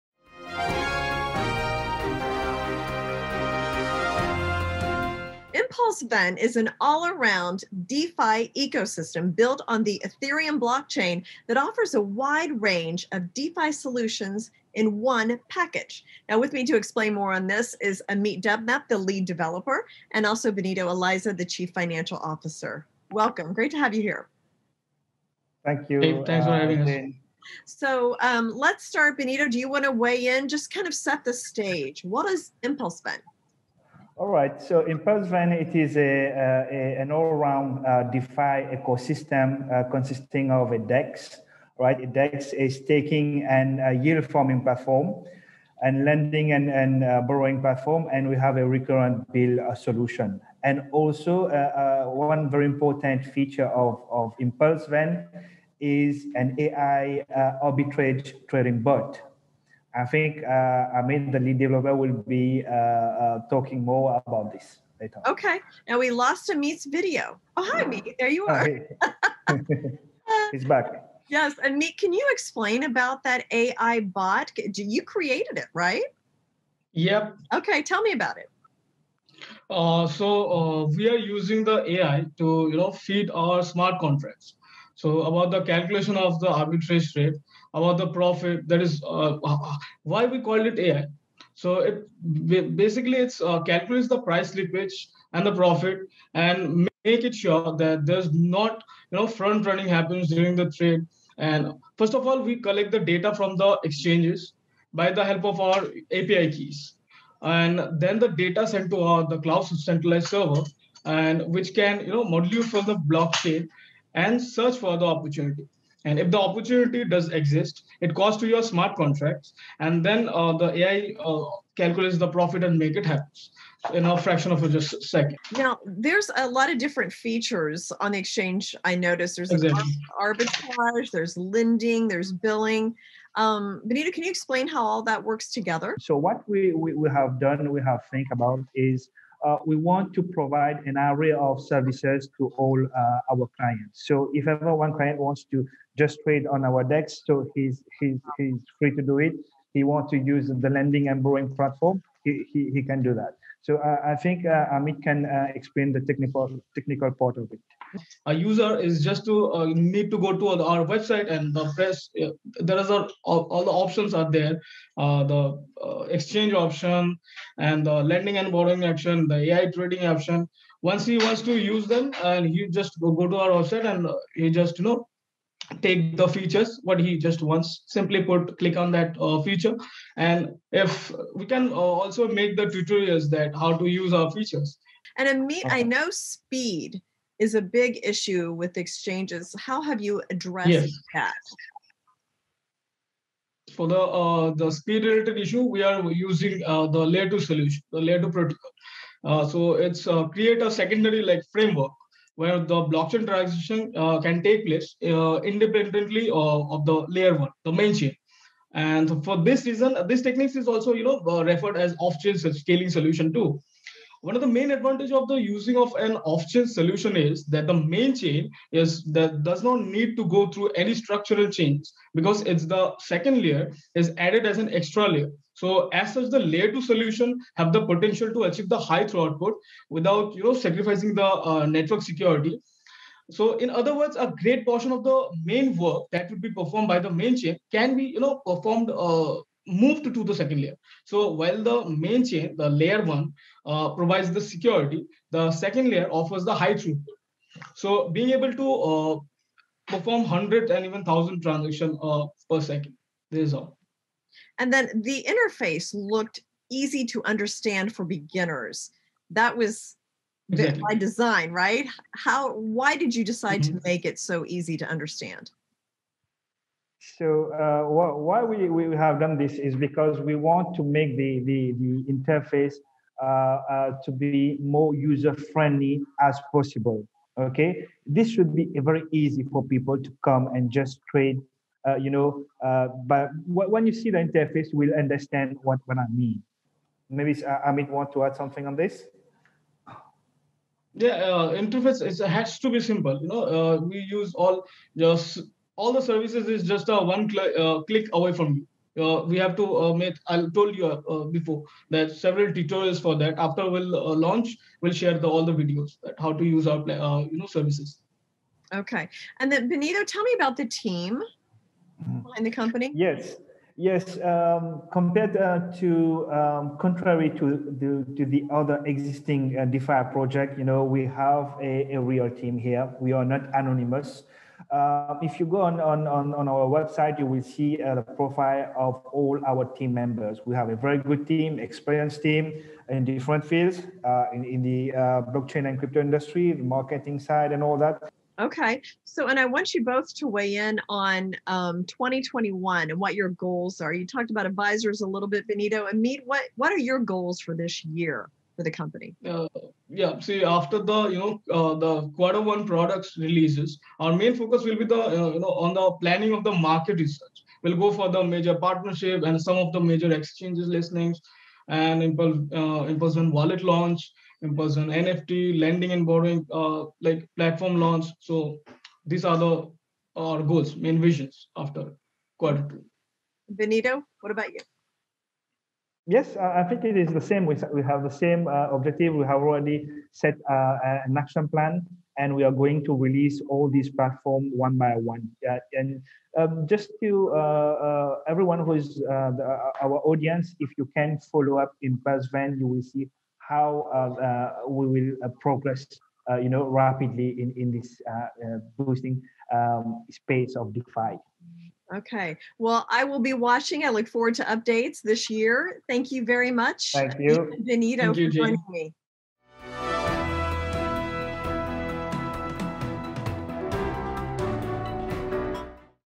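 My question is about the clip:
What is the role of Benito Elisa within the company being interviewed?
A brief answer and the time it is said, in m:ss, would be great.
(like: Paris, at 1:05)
Chief financial officer, at 0:21.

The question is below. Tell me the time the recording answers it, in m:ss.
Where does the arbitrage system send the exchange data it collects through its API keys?
1:49.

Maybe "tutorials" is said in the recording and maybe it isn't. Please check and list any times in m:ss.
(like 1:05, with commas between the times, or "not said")
3:02, 5:02.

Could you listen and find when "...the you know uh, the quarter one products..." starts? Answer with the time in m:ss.
5:50.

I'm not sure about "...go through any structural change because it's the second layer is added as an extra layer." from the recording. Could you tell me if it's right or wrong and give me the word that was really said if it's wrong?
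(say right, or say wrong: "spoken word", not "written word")
right.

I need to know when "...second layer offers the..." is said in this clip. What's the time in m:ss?
4:05.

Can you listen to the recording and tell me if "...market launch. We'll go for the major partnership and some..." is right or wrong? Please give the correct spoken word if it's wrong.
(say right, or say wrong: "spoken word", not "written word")
wrong: "research", not "launch".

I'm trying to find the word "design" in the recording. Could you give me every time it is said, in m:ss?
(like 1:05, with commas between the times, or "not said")
4:20.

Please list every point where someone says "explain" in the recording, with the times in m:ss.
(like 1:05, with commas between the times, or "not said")
0:16, 1:12, 2:14, 2:35.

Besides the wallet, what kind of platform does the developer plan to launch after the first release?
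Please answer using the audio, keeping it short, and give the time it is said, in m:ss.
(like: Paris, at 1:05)
NFT lending and borrowing, at 6:05.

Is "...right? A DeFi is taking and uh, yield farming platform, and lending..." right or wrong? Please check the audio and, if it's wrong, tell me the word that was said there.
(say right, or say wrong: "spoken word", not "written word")
wrong: "DEX", not "DeFi".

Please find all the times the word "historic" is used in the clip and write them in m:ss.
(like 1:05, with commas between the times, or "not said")
not said.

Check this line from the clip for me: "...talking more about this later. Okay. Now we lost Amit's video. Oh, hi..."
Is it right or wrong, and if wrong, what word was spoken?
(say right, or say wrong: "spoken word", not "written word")
right.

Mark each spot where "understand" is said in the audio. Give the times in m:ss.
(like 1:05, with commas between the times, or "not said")
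4:17, 4:24, 4:44.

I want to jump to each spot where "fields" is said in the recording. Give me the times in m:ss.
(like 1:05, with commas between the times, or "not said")
5:33.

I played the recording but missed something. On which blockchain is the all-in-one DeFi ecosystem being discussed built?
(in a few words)
Ethereum.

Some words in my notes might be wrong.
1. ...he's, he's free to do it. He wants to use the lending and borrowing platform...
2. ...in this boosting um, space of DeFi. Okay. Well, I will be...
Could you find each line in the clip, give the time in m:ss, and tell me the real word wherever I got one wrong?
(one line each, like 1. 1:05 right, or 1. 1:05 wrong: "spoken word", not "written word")
1. 2:27 right
2. 6:37 right.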